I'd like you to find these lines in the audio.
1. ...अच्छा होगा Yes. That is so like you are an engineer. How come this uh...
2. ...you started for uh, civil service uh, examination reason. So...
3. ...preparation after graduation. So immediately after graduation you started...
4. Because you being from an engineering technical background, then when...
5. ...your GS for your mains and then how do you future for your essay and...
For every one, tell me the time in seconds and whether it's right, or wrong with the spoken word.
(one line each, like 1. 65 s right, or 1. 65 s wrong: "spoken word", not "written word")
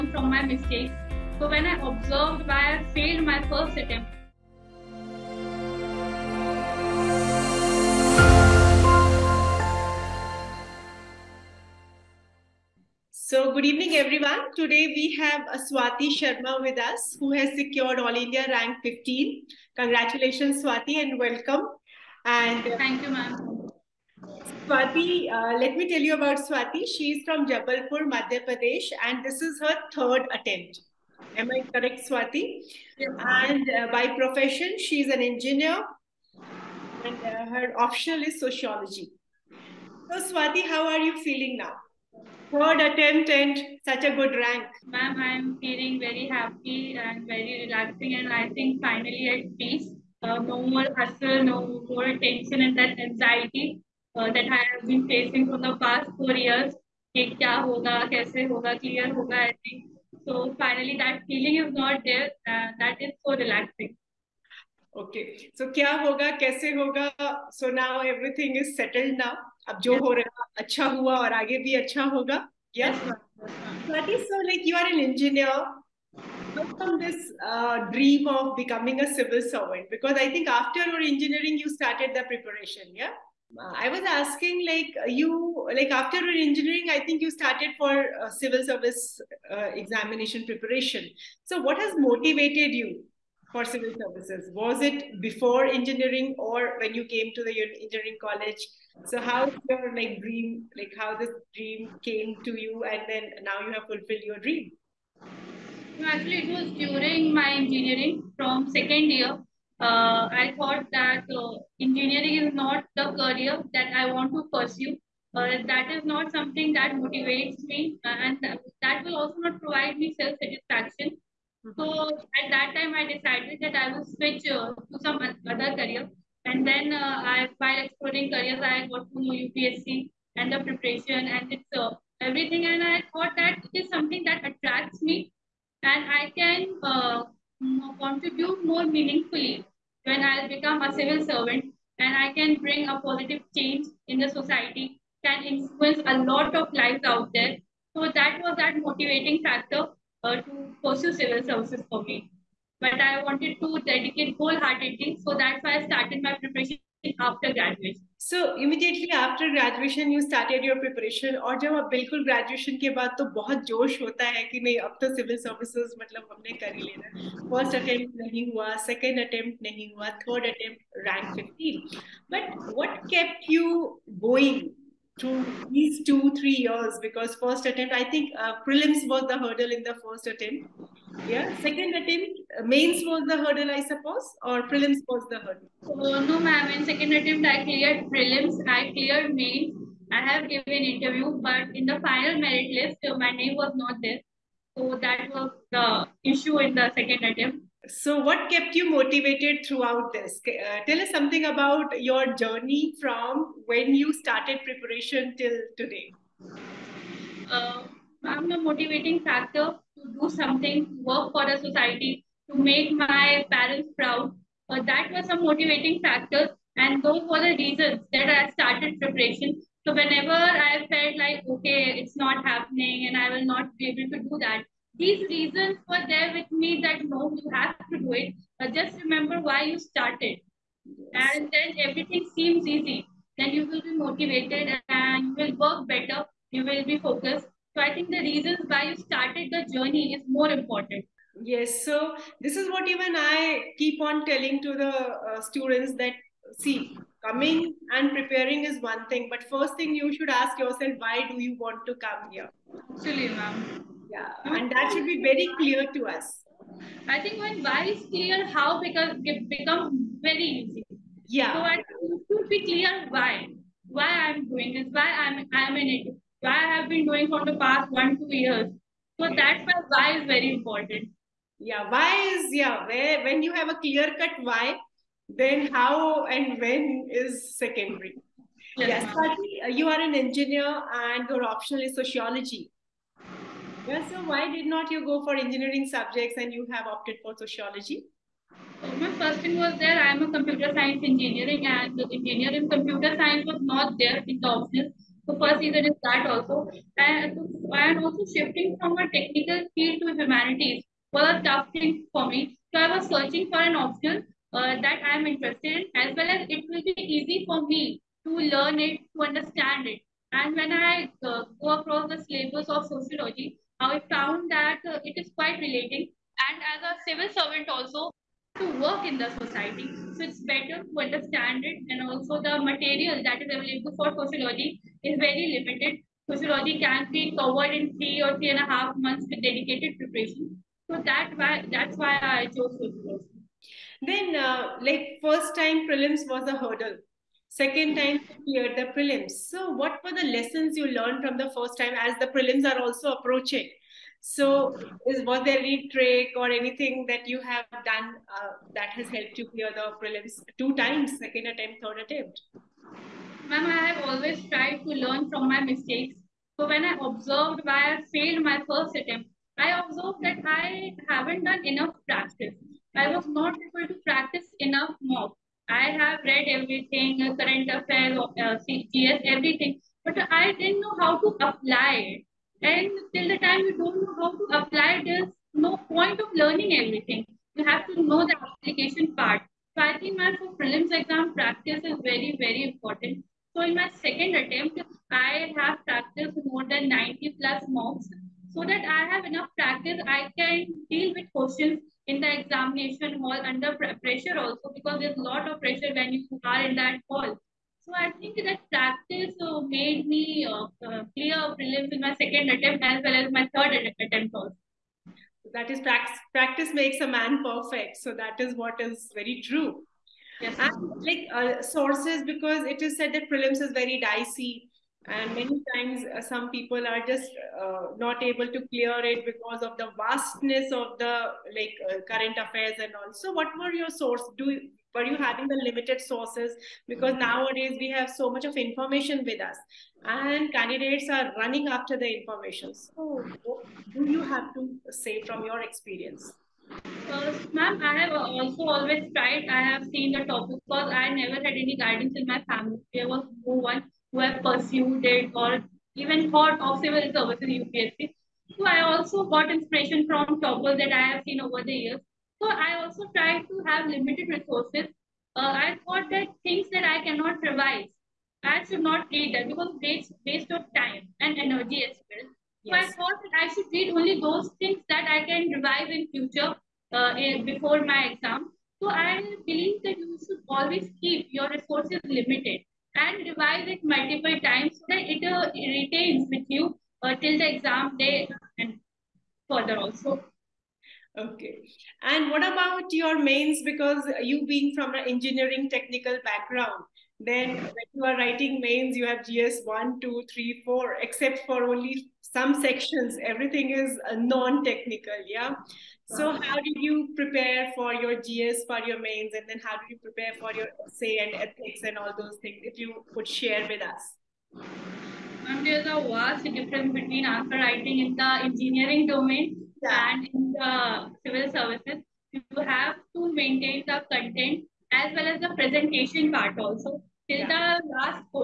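1. 71 s right
2. 87 s wrong: "preparation", not "reason"
3. 156 s right
4. 483 s right
5. 497 s wrong: "prepare", not "future".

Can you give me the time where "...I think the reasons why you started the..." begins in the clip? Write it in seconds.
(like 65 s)
237 s.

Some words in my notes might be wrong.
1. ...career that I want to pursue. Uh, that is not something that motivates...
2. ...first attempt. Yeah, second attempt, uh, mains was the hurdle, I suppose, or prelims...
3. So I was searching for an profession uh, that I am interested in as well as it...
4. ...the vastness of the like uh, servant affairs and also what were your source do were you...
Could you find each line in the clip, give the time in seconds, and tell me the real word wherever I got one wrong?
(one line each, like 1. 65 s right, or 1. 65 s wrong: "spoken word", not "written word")
1. 113 s right
2. 180 s right
3. 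302 s wrong: "option", not "profession"
4. 419 s wrong: "current", not "servant".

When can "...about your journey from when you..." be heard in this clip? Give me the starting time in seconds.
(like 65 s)
201 s.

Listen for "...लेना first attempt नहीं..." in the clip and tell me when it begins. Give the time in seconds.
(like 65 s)
166 s.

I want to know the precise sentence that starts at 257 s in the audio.
I think when why is clear, how because it becomes very easy.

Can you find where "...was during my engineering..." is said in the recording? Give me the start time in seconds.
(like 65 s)
106 s.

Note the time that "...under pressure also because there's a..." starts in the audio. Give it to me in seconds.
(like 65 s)
393 s.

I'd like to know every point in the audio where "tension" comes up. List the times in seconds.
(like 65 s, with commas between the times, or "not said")
52 s.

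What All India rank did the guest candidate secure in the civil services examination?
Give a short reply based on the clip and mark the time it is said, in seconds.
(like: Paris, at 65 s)
15, at 17 s.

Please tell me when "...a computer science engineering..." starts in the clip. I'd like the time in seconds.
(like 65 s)
290 s.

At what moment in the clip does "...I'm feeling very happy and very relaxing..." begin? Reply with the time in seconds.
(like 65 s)
45 s.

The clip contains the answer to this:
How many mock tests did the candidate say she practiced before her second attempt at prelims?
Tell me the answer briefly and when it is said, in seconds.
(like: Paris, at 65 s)
90+, at 386 s.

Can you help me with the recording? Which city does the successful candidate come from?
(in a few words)
Jabalpur.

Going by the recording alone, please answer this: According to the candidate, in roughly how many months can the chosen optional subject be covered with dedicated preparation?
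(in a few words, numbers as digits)
3 to 3.5 months.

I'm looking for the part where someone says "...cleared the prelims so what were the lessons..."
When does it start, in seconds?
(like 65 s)
338 s.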